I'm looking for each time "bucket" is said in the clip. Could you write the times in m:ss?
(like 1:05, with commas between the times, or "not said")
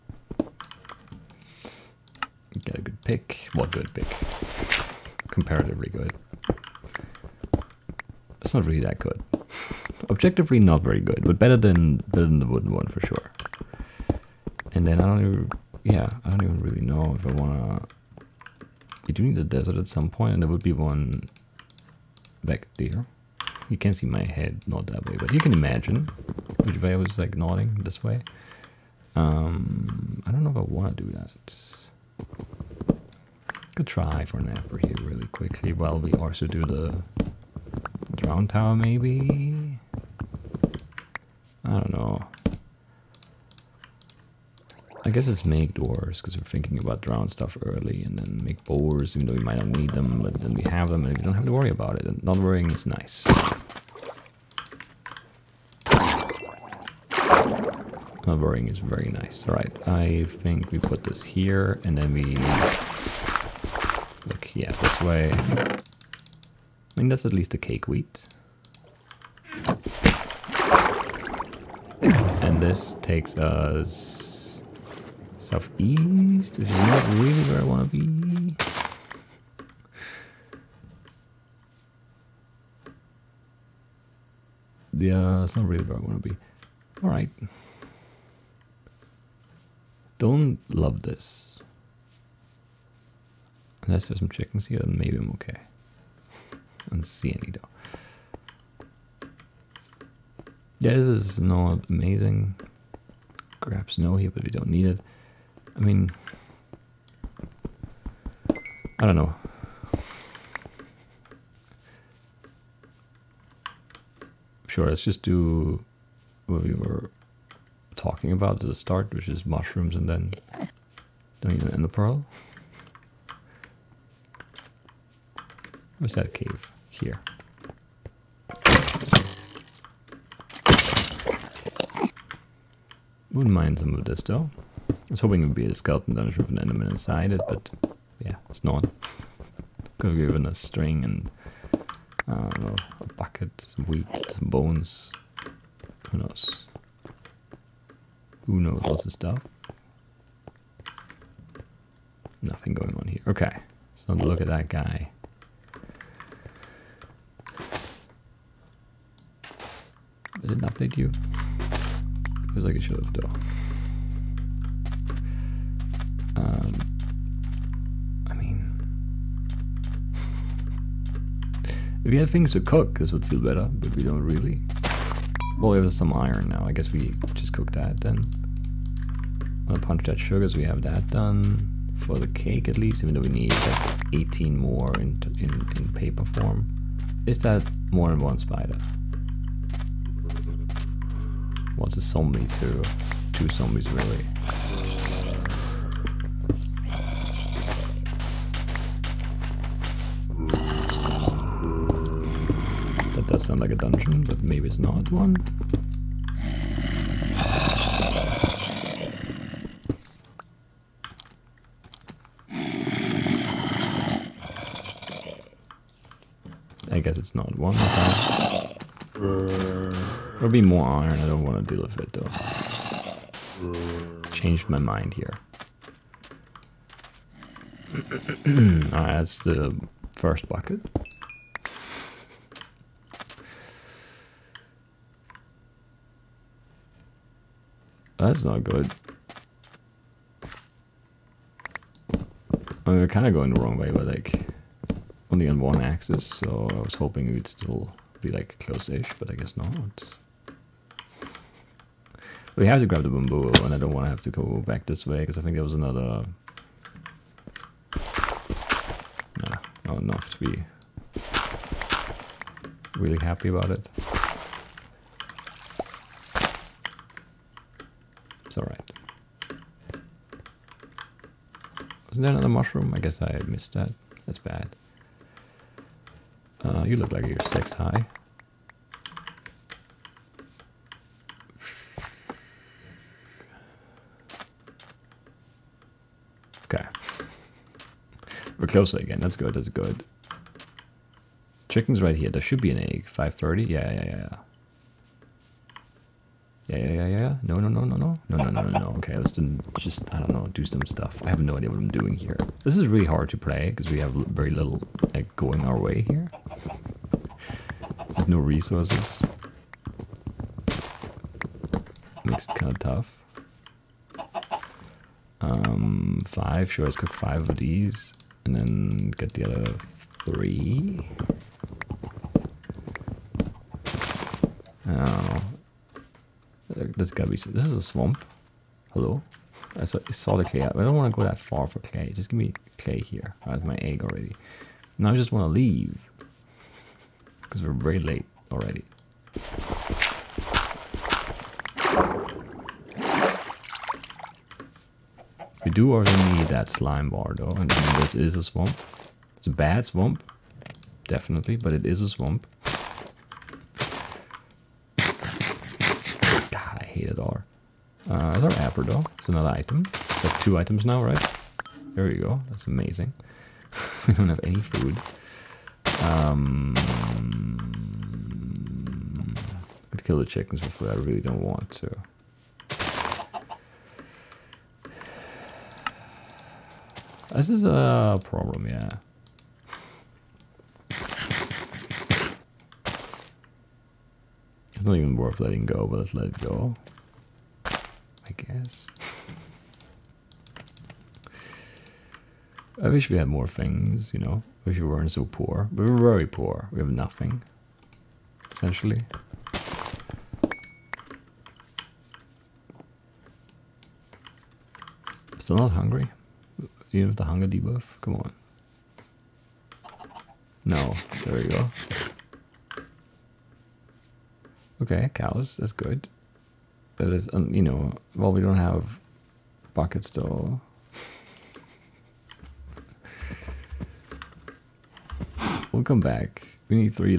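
2:23, 3:50, 6:59.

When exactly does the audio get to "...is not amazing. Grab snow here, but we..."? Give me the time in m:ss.
1:41.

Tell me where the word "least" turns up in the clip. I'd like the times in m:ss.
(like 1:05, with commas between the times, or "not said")
1:07, 3:02.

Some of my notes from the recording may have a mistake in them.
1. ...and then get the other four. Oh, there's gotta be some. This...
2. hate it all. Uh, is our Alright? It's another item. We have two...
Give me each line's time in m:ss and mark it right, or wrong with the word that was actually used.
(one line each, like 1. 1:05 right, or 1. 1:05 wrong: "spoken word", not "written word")
1. 5:18 wrong: "three", not "four"
2. 5:56 wrong: "Aperdo", not "Alright".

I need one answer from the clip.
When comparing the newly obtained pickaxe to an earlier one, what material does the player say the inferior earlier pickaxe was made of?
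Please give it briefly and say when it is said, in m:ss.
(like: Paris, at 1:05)
wooden, at 0:12.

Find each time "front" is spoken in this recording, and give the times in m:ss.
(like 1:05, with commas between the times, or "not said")
not said.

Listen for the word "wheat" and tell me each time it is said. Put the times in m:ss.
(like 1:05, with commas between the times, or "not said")
1:07, 2:23.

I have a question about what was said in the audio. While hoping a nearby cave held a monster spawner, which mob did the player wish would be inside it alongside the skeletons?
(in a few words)
enderman.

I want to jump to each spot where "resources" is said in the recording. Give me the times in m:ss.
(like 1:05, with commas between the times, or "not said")
5:08.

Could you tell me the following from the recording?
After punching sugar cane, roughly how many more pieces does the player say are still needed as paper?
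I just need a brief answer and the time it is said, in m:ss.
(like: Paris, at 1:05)
18, at 3:04.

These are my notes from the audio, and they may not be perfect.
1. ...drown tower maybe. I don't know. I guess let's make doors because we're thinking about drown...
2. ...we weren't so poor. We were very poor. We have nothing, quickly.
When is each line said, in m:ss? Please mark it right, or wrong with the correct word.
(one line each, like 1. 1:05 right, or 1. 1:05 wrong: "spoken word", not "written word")
1. 0:38 right
2. 6:34 wrong: "essentially", not "quickly".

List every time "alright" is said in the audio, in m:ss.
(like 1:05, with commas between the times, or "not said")
0:59, 1:27, 3:48, 4:28.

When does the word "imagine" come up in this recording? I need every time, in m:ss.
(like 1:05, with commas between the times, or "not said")
0:25.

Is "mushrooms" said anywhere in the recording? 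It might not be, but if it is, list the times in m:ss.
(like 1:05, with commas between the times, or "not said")
1:59, 4:32.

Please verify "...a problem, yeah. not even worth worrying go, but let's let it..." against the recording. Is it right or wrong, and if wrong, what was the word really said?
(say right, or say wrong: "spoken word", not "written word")
wrong: "letting", not "worrying".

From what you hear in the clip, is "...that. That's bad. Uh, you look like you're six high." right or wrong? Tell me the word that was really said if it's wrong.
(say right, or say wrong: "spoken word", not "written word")
right.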